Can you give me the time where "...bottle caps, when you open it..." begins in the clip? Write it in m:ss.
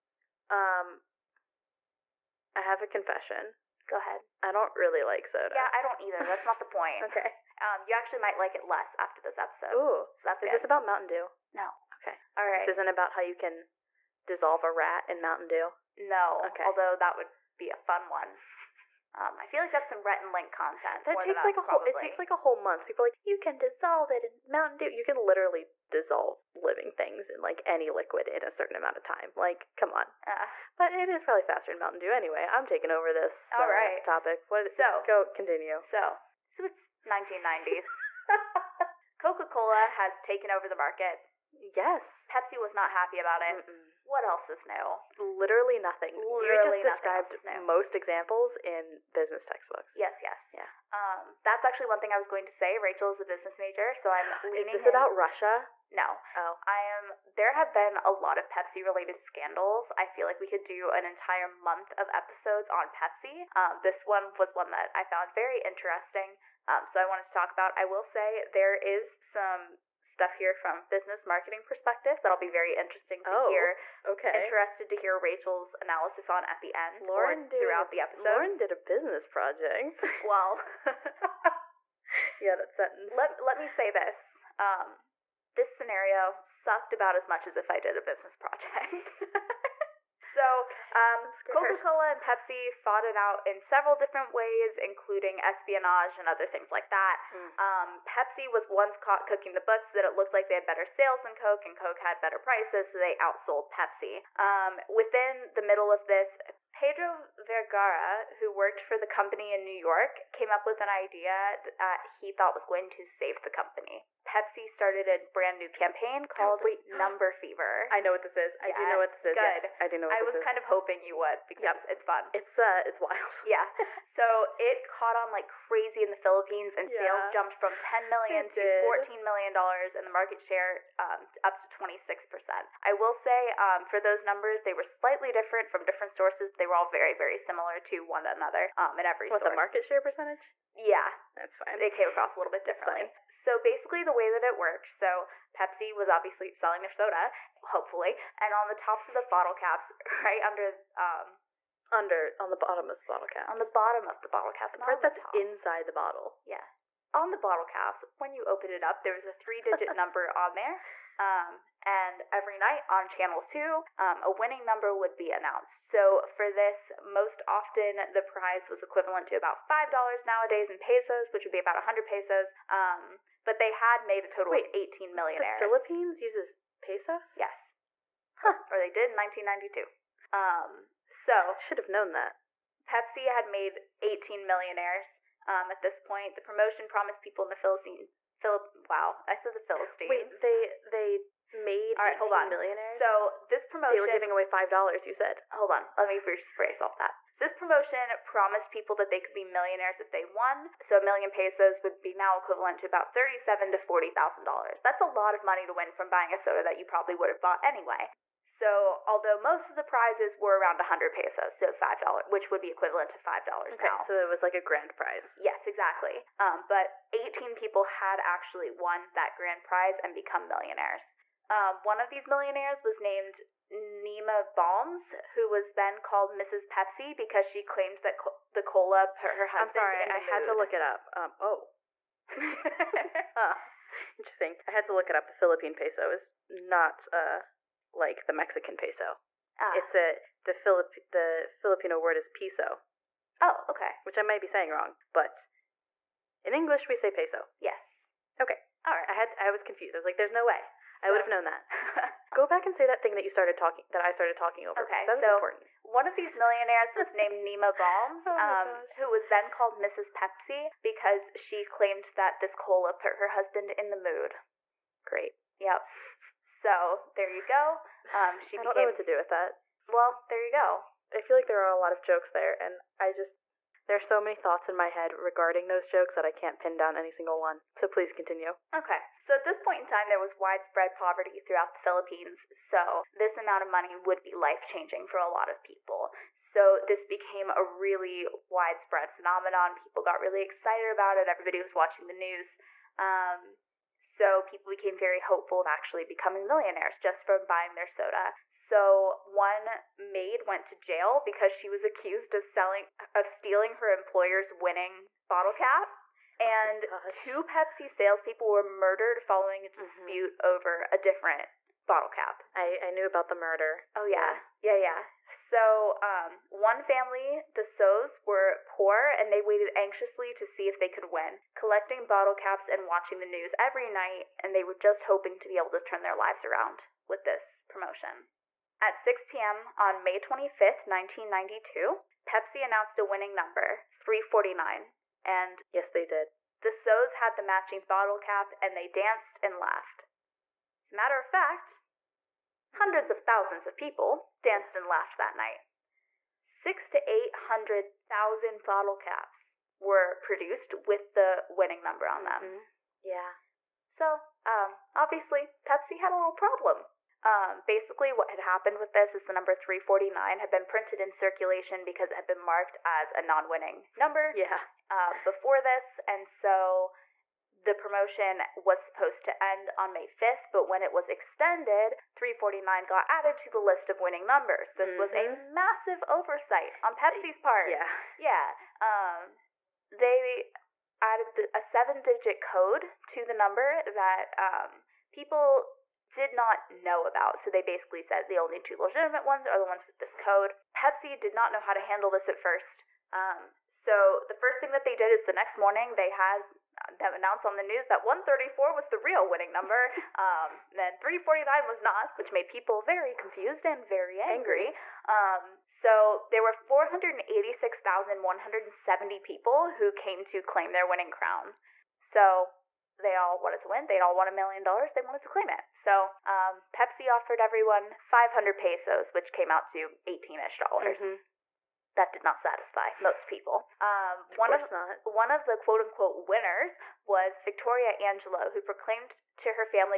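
2:37.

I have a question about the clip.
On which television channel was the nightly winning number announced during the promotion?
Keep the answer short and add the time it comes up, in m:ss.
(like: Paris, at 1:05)
Channel 2, at 2:43.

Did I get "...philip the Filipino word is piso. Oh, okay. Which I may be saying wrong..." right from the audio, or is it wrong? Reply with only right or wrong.
right.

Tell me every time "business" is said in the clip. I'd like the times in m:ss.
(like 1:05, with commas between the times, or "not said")
0:49, 0:53, 1:10, 1:18, 1:28.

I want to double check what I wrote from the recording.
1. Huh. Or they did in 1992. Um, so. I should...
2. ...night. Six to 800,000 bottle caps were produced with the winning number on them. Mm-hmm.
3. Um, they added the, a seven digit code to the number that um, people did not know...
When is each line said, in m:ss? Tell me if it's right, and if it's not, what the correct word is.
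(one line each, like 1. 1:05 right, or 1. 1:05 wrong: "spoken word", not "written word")
1. 2:58 right
2. 5:45 right
3. 6:18 right.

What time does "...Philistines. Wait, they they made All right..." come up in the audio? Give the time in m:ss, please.
3:09.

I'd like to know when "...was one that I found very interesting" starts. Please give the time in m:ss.
1:04.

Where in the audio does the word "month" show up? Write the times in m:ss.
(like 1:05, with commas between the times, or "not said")
0:22, 1:01.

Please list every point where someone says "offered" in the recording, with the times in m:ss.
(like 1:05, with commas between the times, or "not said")
6:57.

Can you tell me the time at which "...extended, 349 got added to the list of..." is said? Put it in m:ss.
6:11.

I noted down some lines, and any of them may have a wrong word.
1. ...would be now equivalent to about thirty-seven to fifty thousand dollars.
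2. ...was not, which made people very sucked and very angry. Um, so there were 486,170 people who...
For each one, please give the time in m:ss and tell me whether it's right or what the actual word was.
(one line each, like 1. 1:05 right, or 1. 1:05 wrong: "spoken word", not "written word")
1. 3:21 wrong: "forty", not "fifty"
2. 6:41 wrong: "confused", not "sucked".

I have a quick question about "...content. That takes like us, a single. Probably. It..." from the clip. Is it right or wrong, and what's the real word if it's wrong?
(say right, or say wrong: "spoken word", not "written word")
wrong: "whole", not "single".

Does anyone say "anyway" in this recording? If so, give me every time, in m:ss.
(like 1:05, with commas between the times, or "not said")
0:32, 3:27.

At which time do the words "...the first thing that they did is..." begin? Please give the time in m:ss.
6:34.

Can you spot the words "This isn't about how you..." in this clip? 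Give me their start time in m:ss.
0:12.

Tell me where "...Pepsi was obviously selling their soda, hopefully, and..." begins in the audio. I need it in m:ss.
2:25.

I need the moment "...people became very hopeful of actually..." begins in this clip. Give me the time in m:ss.
4:54.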